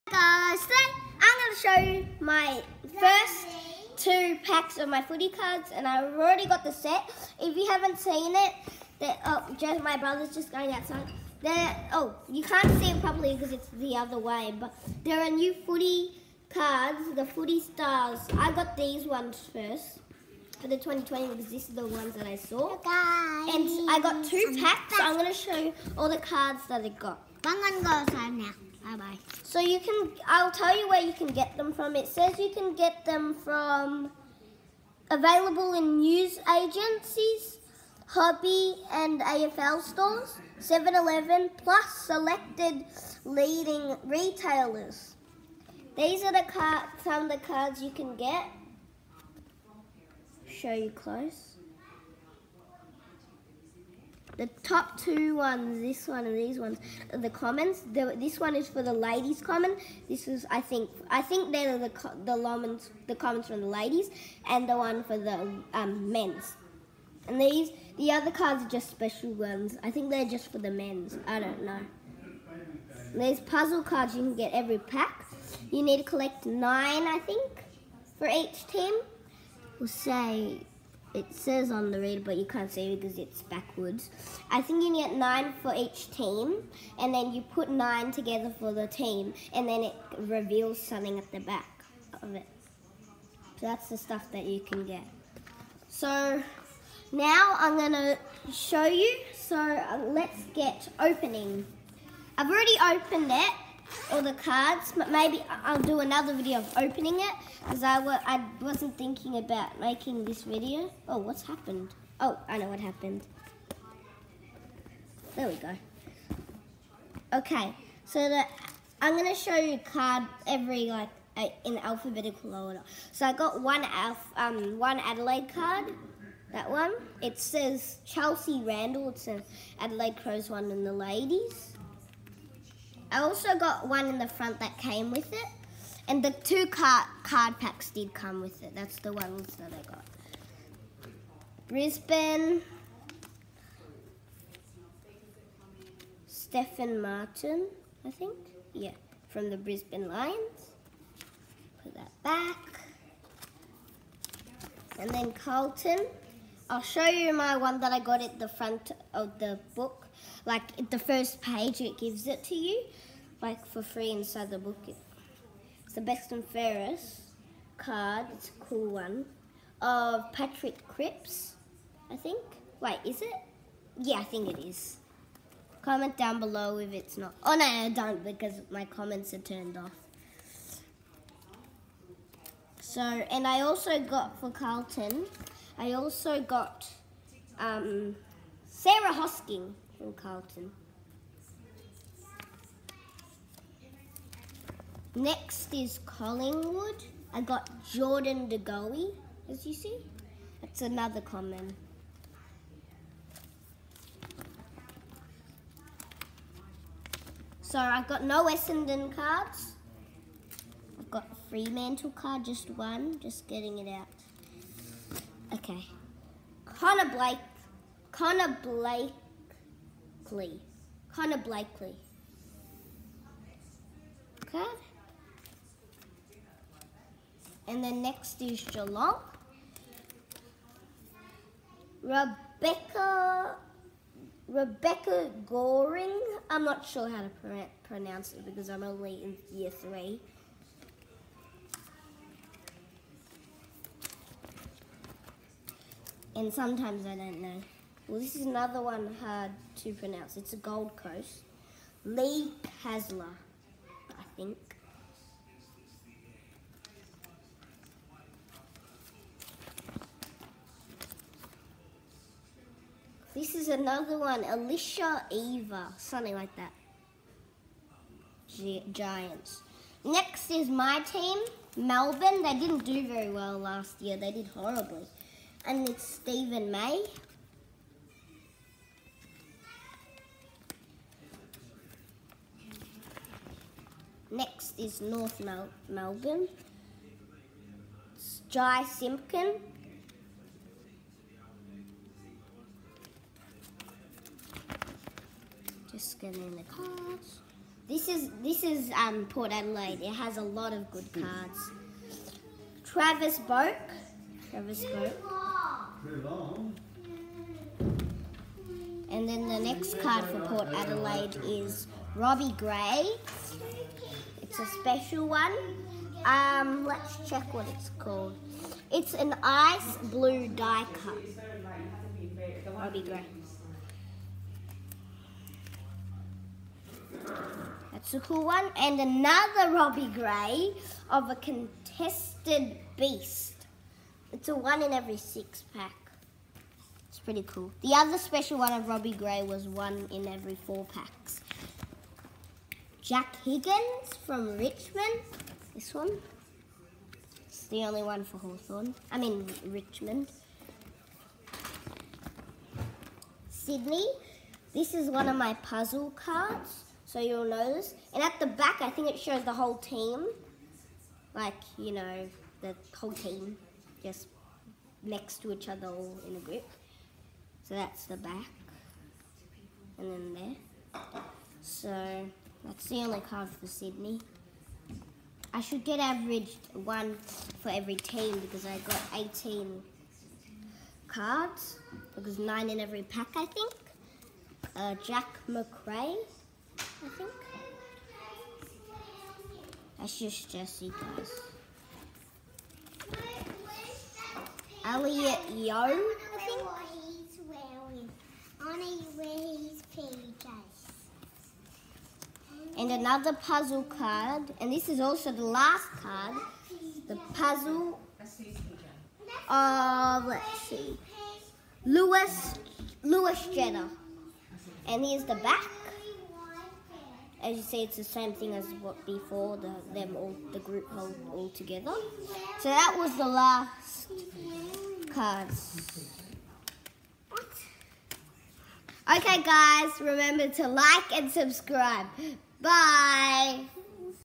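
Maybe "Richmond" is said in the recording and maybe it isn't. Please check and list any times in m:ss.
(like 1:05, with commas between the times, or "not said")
5:44, 5:49.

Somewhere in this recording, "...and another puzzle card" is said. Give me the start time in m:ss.
6:42.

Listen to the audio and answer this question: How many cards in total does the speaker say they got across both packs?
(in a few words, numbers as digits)
18.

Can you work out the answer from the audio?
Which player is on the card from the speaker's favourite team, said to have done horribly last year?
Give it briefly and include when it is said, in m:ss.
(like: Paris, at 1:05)
Steven May, at 4:36.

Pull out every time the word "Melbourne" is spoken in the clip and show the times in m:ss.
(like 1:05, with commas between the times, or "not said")
4:31, 4:45.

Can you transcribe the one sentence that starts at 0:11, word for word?
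There, oh, you can't see it properly because it's the other way, but there are new footy cards, the footy stars.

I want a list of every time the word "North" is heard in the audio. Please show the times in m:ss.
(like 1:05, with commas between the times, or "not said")
4:45.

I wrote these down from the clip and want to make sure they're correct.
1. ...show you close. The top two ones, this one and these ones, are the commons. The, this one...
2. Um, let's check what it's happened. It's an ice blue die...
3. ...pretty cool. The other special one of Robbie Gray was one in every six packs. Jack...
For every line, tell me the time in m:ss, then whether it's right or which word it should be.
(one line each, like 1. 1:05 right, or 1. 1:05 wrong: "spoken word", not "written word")
1. 0:50 right
2. 5:16 wrong: "called", not "happened"
3. 5:37 wrong: "four", not "six".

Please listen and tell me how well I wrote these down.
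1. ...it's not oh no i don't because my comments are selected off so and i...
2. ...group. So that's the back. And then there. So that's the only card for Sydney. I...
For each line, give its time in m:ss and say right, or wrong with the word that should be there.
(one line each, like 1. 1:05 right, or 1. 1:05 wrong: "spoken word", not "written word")
1. 2:56 wrong: "turned", not "selected"
2. 6:06 right.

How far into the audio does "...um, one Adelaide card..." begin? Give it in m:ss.
2:04.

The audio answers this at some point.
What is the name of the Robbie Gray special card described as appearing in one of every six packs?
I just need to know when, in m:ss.
5:31.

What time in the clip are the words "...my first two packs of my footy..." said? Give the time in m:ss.
0:02.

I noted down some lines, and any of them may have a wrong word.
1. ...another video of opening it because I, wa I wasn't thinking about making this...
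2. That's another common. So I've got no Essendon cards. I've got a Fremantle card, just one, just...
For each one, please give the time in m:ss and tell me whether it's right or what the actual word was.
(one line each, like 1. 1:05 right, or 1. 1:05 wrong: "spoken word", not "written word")
1. 1:45 right
2. 3:20 right.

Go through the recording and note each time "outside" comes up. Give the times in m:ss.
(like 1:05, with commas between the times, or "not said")
0:10, 0:27.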